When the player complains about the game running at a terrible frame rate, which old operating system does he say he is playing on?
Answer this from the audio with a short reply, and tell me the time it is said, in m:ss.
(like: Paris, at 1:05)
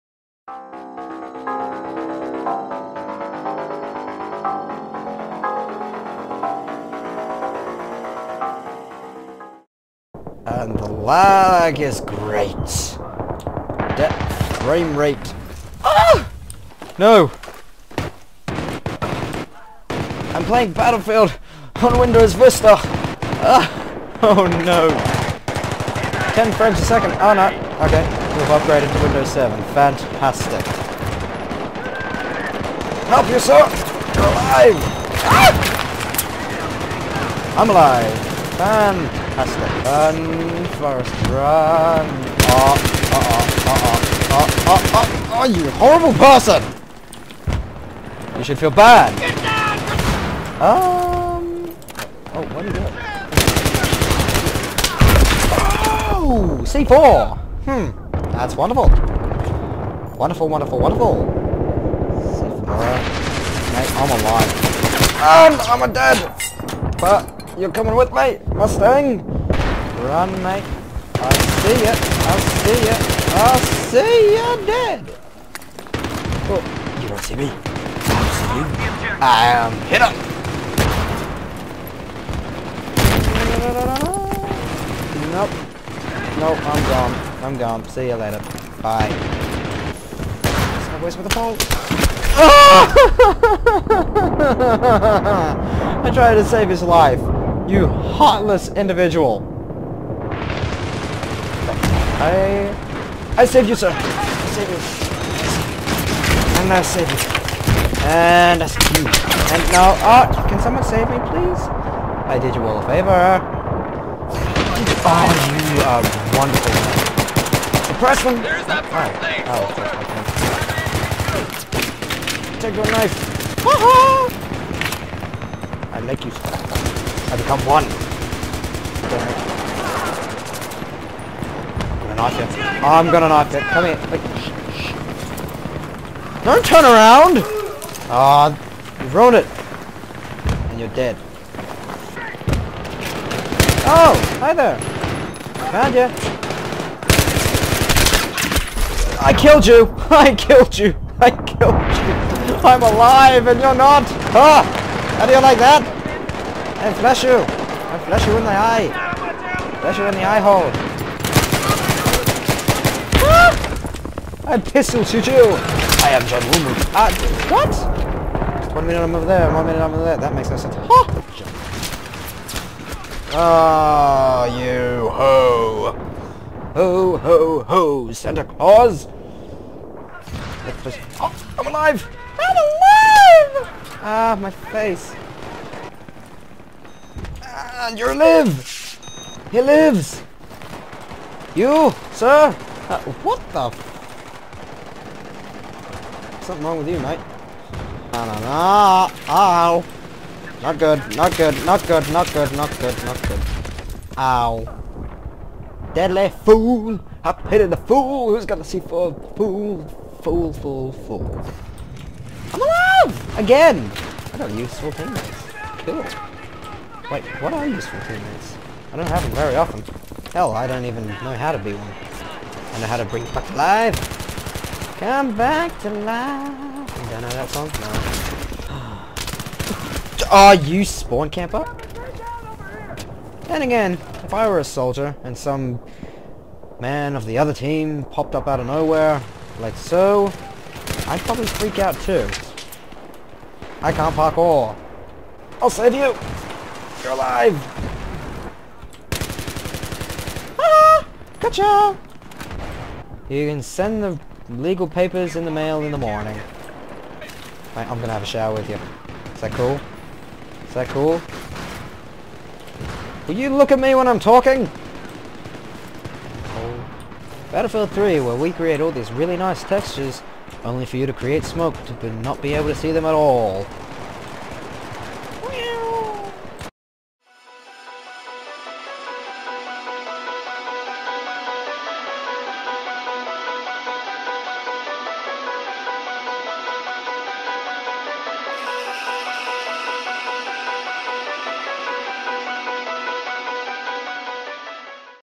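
Windows Vista, at 0:21.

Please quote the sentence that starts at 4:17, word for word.
Right, I'm gonna have a shower with you.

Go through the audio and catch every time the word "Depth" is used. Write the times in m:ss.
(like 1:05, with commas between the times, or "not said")
0:13.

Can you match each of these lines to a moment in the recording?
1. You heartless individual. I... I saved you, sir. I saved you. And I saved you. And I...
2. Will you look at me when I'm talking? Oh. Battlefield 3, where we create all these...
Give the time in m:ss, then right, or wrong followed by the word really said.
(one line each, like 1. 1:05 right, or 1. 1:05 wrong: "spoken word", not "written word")
1. 1:37 right
2. 4:23 right.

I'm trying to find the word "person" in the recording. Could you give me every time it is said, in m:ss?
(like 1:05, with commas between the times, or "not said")
0:46, 1:58.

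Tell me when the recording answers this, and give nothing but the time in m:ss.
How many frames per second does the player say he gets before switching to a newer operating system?
0:26.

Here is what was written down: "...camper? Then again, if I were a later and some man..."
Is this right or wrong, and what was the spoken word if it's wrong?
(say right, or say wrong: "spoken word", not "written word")
wrong: "soldier", not "later".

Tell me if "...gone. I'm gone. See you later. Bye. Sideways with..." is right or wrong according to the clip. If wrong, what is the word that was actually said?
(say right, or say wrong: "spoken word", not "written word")
right.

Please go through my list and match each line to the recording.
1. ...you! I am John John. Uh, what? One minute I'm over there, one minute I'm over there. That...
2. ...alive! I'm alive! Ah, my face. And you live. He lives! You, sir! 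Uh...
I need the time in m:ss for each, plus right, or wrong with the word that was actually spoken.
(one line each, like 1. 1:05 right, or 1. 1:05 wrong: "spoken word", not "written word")
1. 2:45 wrong: "Woo", not "John"
2. 3:01 right.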